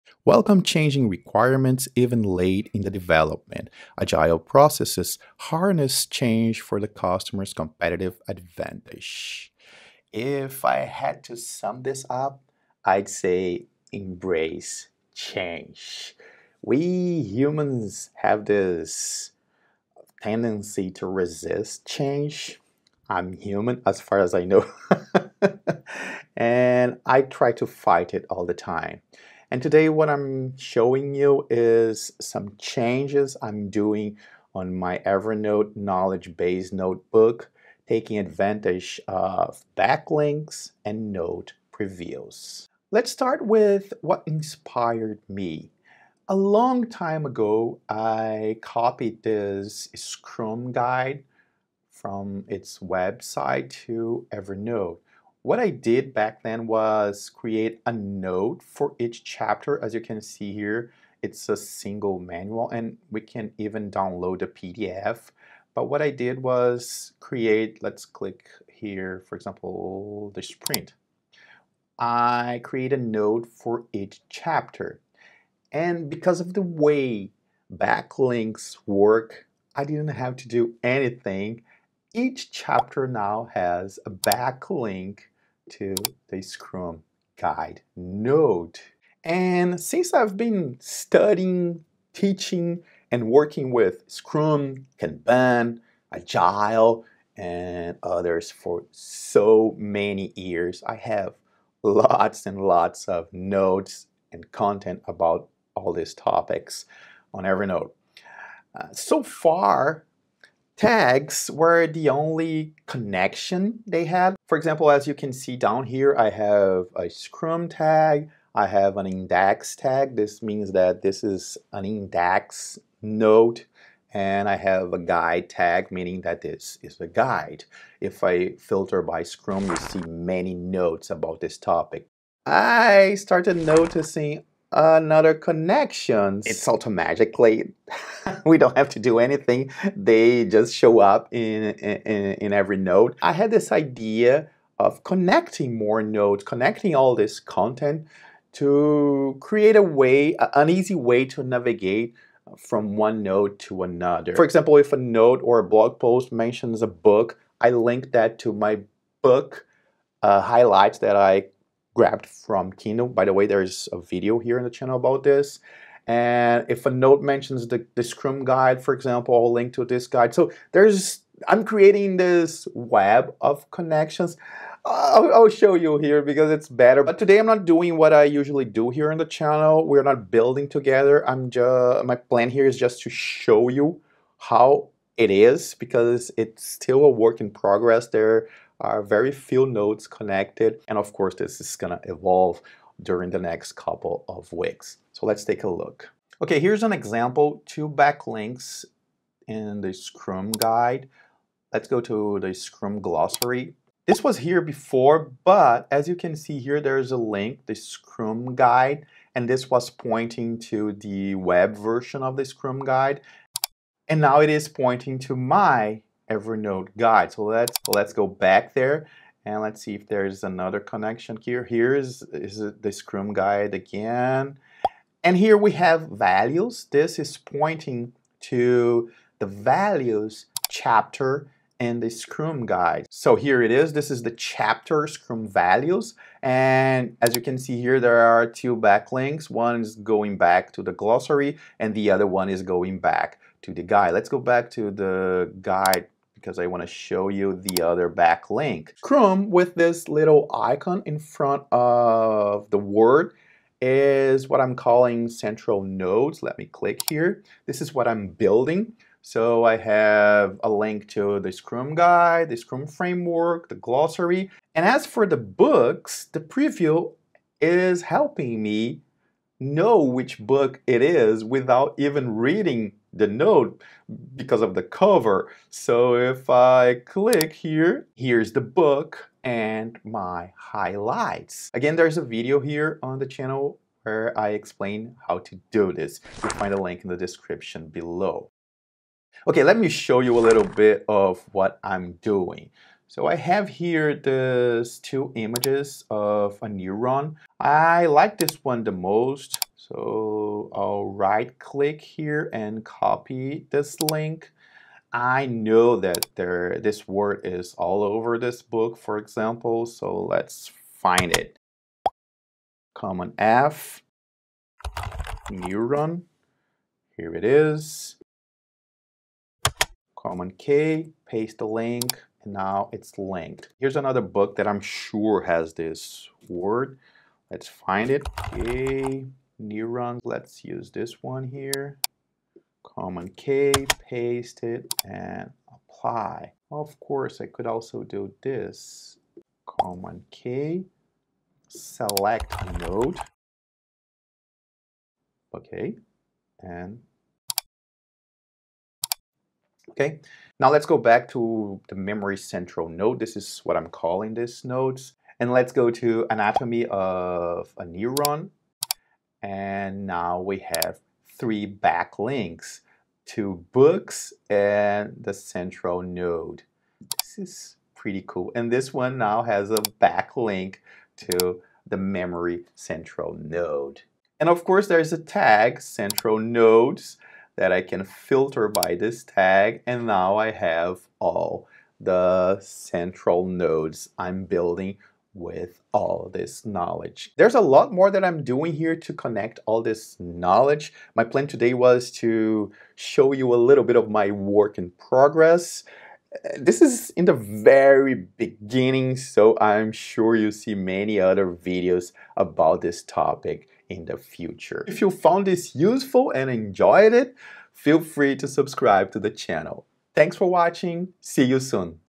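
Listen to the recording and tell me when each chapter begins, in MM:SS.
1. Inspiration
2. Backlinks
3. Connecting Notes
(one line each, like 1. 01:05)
1. 00:42
2. 02:09
3. 04:45.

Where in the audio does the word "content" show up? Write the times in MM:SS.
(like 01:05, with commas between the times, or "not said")
01:44, 02:27.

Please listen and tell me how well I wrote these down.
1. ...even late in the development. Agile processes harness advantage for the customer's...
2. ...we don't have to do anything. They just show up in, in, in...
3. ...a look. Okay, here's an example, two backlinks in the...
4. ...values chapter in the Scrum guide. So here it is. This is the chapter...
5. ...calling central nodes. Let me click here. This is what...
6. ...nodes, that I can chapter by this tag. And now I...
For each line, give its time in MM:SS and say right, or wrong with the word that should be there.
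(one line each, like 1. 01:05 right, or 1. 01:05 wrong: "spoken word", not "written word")
1. 00:01 wrong: "change", not "advantage"
2. 02:18 right
3. 03:15 right
4. 03:49 right
5. 04:14 right
6. 06:16 wrong: "filter", not "chapter".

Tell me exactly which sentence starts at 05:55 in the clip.
And let's go to anatomy of a neuron and now we have three backlinks to books and the central node.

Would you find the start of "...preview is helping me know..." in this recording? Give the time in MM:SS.
04:26.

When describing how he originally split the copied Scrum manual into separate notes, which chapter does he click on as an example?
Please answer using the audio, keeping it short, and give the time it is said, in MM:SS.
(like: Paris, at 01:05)
The sprint, at 01:10.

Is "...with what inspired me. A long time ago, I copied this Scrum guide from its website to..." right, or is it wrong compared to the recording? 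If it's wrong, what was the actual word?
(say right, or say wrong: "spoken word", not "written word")
right.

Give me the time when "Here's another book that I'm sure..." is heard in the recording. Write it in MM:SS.
05:23.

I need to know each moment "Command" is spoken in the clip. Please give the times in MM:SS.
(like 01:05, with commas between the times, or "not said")
05:12, 05:20, 05:32, 05:39.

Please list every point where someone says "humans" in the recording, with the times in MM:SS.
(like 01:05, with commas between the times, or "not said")
00:17, 00:23.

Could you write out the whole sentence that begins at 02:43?
By the way, there's a video here in the channel about this.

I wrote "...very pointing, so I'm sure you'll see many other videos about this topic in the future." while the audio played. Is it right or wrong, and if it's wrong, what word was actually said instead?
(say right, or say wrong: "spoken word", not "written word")
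wrong: "beginning", not "pointing".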